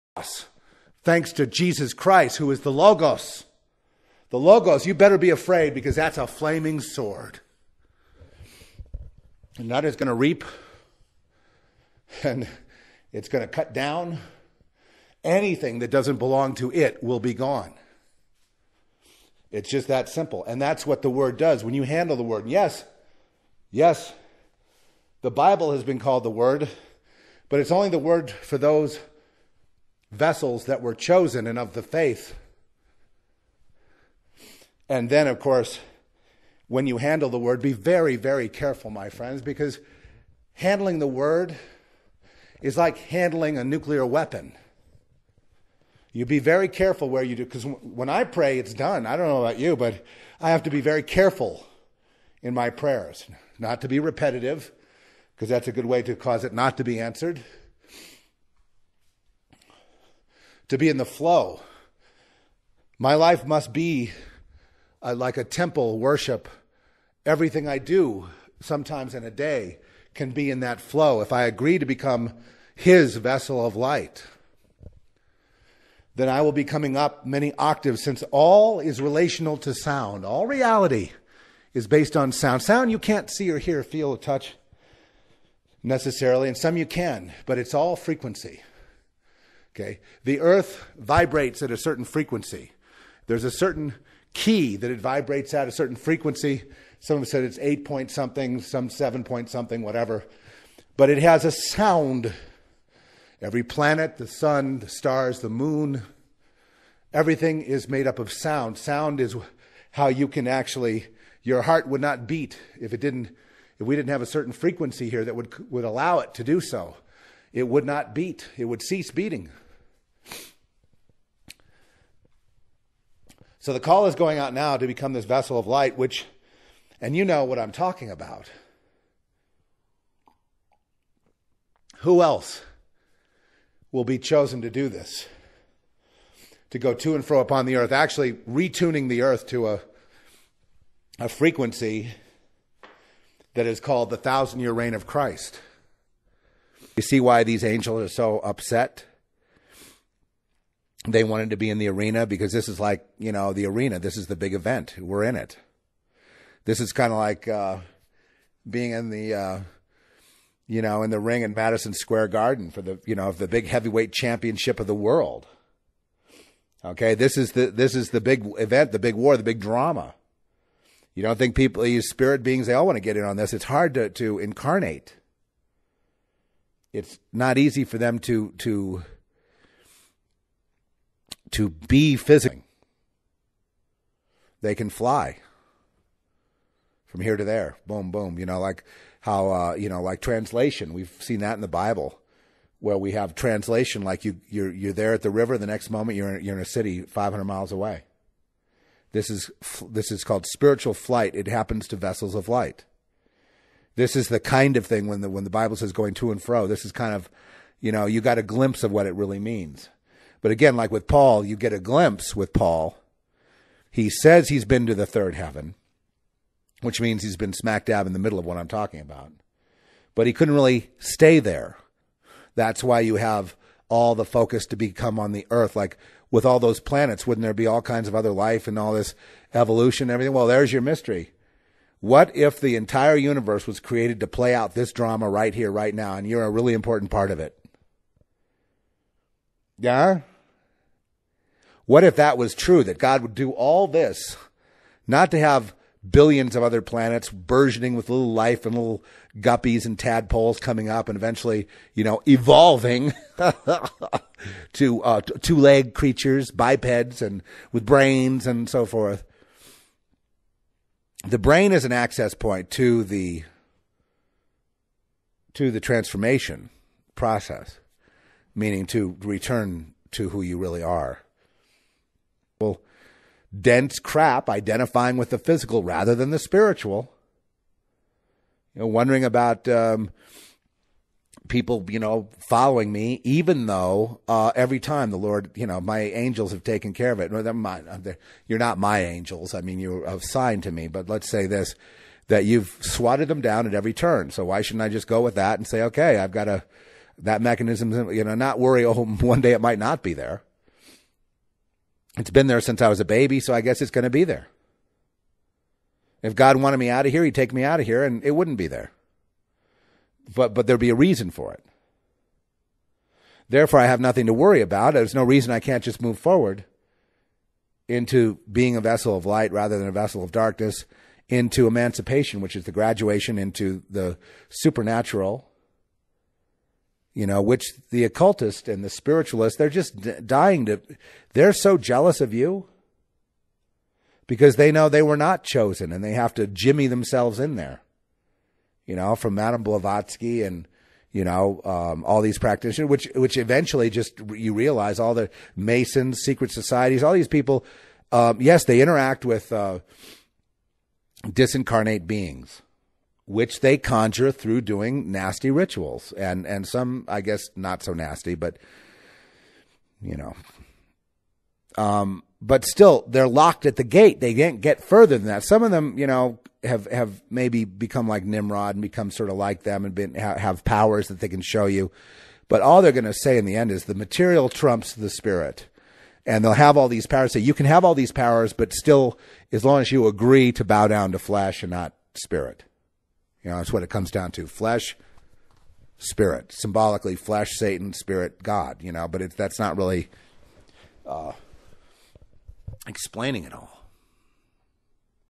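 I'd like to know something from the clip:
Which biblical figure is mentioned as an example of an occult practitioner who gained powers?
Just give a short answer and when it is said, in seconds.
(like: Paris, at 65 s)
Nimrod, at 368 s.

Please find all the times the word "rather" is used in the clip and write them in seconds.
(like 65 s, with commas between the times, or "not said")
275 s, 319 s.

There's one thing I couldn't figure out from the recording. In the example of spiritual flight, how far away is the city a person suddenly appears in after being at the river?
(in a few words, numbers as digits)
500 miles.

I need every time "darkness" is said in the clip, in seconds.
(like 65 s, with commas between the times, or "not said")
320 s.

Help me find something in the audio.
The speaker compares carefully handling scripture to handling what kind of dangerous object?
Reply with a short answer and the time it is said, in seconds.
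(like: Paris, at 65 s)
nuclear weapon, at 43 s.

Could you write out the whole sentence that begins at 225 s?
Like with all those planets, wouldn't there be all kinds of other life and all this evolution and everything?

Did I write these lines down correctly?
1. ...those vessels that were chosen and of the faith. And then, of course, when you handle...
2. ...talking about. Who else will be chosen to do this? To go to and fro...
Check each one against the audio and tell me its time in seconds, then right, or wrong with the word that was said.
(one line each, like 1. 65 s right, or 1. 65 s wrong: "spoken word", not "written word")
1. 28 s right
2. 127 s right.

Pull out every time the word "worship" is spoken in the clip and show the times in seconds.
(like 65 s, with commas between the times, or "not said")
65 s.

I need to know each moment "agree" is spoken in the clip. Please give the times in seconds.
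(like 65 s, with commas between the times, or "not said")
71 s, 380 s.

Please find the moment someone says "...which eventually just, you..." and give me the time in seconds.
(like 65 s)
343 s.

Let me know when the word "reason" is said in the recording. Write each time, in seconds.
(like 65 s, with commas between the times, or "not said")
310 s, 315 s.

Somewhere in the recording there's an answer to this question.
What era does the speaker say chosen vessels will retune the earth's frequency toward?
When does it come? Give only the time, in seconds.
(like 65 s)
144 s.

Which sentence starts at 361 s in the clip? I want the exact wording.
Um, but still, they're locked at the gate.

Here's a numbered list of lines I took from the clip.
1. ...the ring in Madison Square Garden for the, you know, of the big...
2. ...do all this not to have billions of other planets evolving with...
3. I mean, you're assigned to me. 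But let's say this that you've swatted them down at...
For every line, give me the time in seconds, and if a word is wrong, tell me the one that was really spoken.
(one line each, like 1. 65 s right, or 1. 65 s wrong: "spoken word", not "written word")
1. 161 s right
2. 243 s wrong: "burgeoning", not "evolving"
3. 289 s right.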